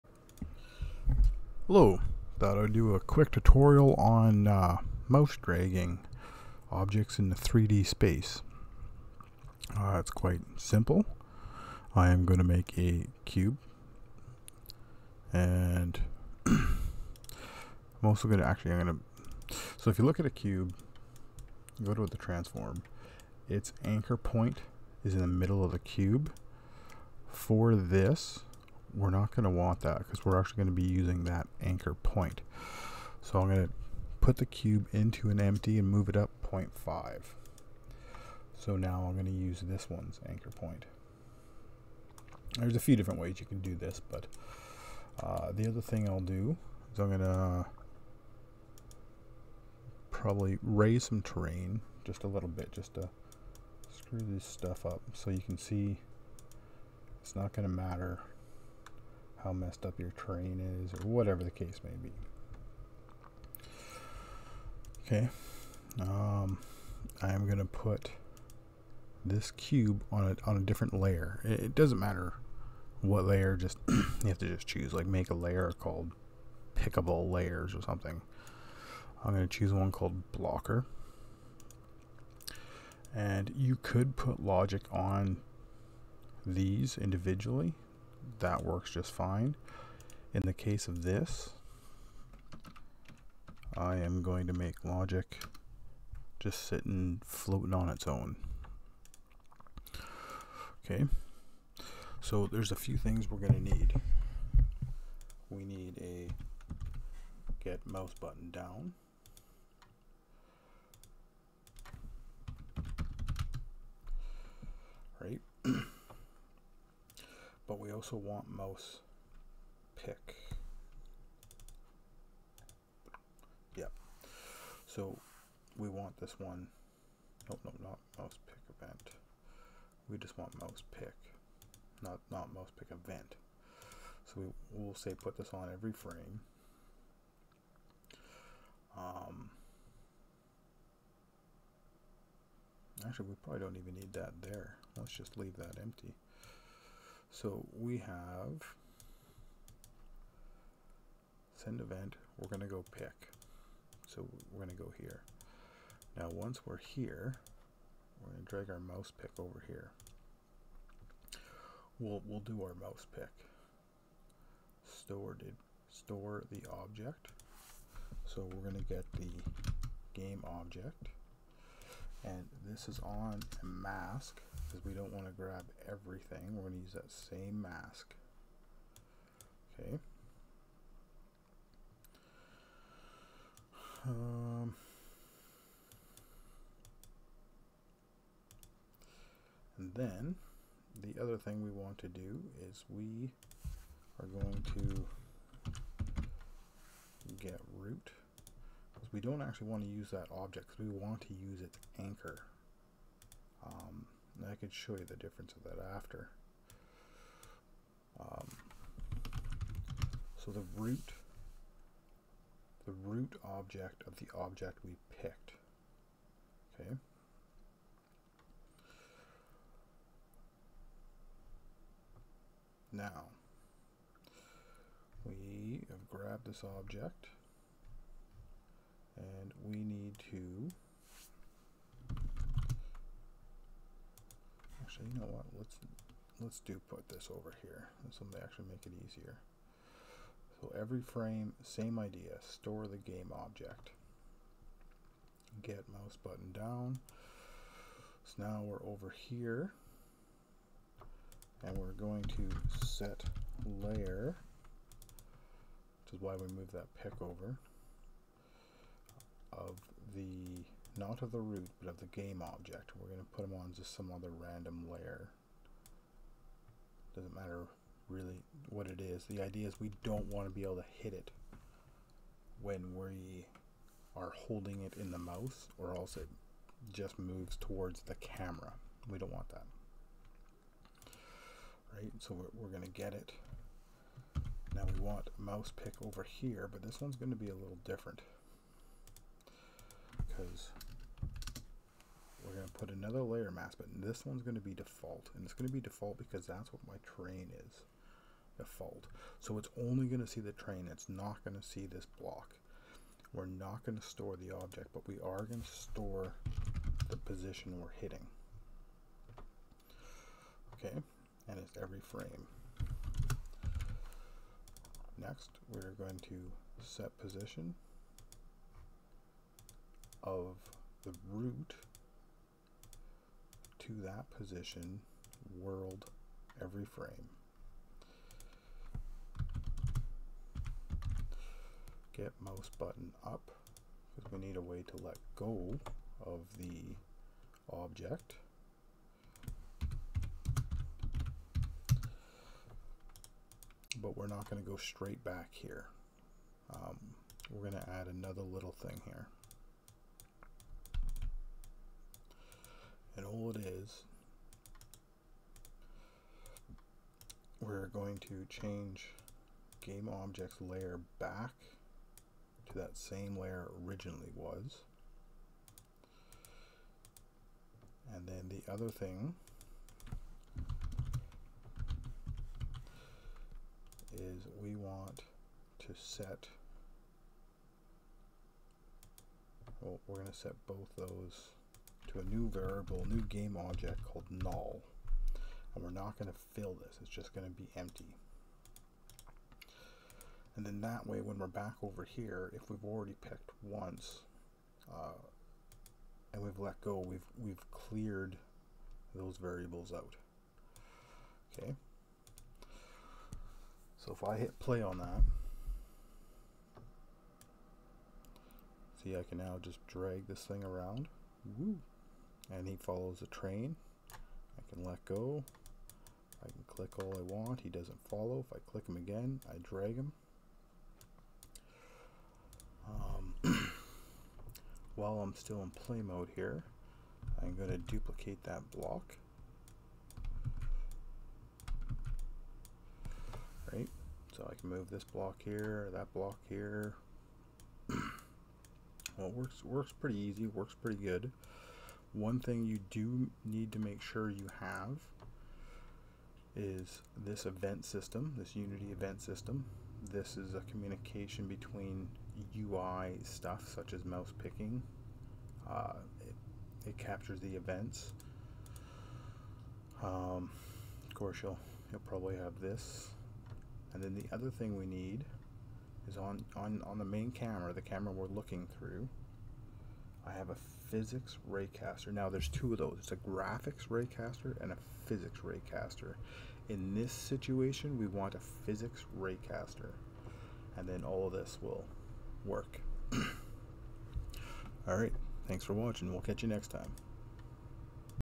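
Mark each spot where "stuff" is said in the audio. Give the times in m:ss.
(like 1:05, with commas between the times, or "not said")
0:54, 7:33.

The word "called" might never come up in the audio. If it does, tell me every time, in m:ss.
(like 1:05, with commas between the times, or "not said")
1:15, 1:19, 6:24.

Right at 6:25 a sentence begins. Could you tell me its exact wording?
And we're not going to fill this, it's just going to be empty.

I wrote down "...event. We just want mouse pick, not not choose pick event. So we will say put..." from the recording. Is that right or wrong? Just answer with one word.
wrong.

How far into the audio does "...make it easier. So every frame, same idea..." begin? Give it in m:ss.
3:58.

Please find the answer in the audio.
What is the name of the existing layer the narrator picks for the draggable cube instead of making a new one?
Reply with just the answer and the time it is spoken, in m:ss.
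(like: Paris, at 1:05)
blocker, at 1:20.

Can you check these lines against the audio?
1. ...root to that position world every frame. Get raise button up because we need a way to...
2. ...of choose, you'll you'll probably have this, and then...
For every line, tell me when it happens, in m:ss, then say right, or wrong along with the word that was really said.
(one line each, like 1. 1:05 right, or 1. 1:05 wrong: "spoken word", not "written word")
1. 5:21 wrong: "mouse", not "raise"
2. 7:41 wrong: "course", not "choose".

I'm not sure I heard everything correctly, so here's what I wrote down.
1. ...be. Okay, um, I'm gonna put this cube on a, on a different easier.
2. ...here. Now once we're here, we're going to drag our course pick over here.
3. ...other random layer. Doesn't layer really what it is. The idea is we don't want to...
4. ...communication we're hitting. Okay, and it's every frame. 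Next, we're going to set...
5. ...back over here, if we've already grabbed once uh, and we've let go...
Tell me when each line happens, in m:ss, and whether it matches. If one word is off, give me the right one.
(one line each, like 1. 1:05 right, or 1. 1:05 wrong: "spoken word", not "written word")
1. 1:02 wrong: "layer", not "easier"
2. 2:34 wrong: "mouse", not "course"
3. 4:24 wrong: "matter", not "layer"
4. 5:07 wrong: "position", not "communication"
5. 6:31 wrong: "picked", not "grabbed".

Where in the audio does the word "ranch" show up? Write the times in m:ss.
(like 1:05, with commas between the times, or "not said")
not said.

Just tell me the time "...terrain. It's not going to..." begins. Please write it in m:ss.
5:00.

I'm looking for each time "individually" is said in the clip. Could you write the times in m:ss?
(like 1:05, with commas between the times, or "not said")
1:26.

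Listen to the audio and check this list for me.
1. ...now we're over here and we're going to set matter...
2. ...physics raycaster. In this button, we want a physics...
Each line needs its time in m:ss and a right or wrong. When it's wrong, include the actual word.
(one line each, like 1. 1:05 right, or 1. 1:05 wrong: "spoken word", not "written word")
1. 4:08 wrong: "layer", not "matter"
2. 7:55 wrong: "situation", not "button".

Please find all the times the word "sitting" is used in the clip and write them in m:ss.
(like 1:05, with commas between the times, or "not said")
1:36.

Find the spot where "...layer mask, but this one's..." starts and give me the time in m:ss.
4:53.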